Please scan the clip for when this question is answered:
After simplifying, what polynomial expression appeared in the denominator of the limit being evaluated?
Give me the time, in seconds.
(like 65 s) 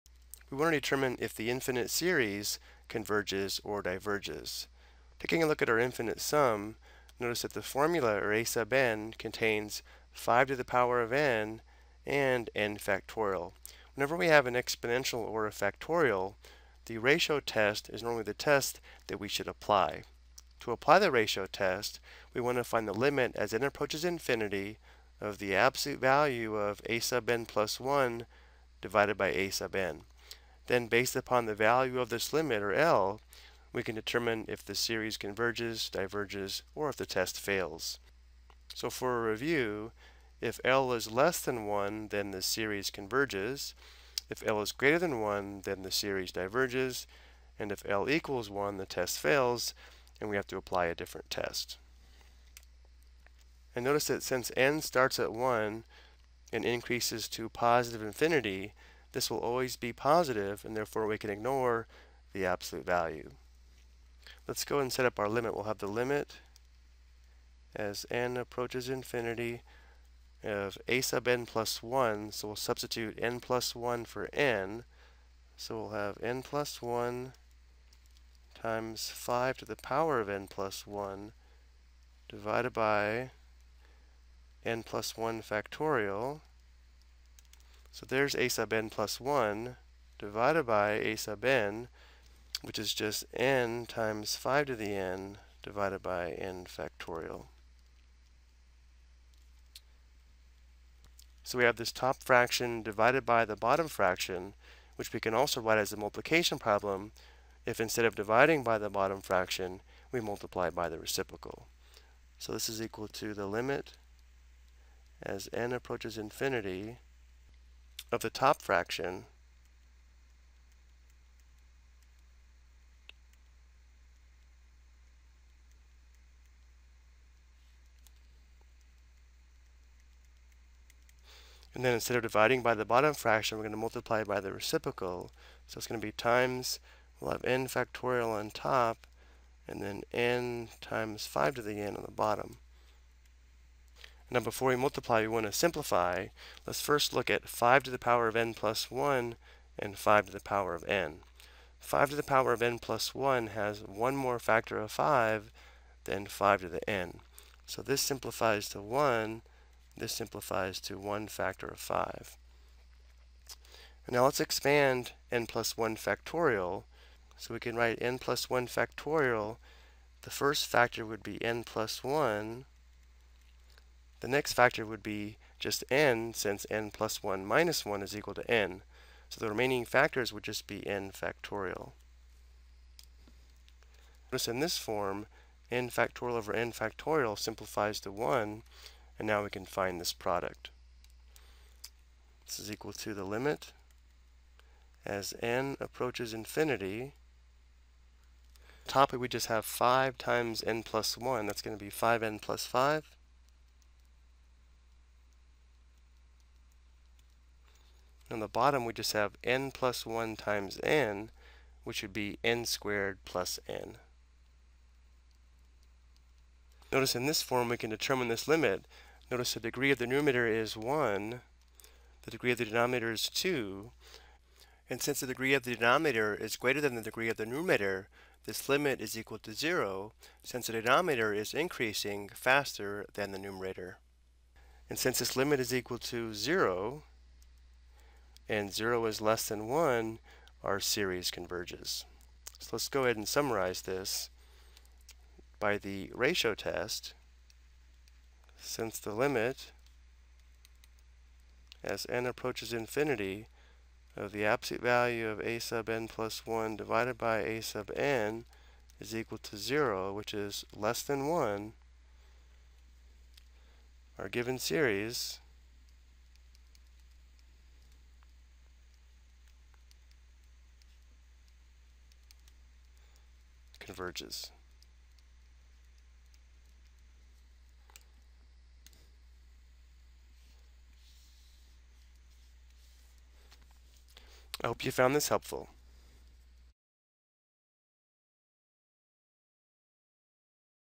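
212 s.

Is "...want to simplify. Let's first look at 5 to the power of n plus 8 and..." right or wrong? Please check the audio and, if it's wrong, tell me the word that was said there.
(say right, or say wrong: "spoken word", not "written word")
wrong: "1", not "8".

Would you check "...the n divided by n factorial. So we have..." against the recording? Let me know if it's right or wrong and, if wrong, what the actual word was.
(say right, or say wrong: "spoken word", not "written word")
right.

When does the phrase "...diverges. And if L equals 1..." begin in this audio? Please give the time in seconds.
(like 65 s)
46 s.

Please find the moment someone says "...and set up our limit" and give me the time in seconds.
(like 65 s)
64 s.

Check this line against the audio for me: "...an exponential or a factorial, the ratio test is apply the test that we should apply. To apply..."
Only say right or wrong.
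wrong.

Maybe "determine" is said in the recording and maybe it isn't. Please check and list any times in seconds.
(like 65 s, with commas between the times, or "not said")
0 s, 33 s, 217 s.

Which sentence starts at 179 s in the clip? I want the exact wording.
So the remaining factors would just be n factorial.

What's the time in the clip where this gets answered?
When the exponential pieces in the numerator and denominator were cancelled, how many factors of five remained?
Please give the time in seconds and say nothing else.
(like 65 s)
160 s.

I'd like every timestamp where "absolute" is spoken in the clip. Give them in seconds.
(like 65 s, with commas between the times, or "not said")
25 s, 62 s, 254 s.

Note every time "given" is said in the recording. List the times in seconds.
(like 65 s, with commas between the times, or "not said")
264 s.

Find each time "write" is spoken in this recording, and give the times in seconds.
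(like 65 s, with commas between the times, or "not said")
105 s, 167 s.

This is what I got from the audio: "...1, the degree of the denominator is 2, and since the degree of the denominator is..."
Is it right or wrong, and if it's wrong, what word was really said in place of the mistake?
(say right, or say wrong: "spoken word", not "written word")
right.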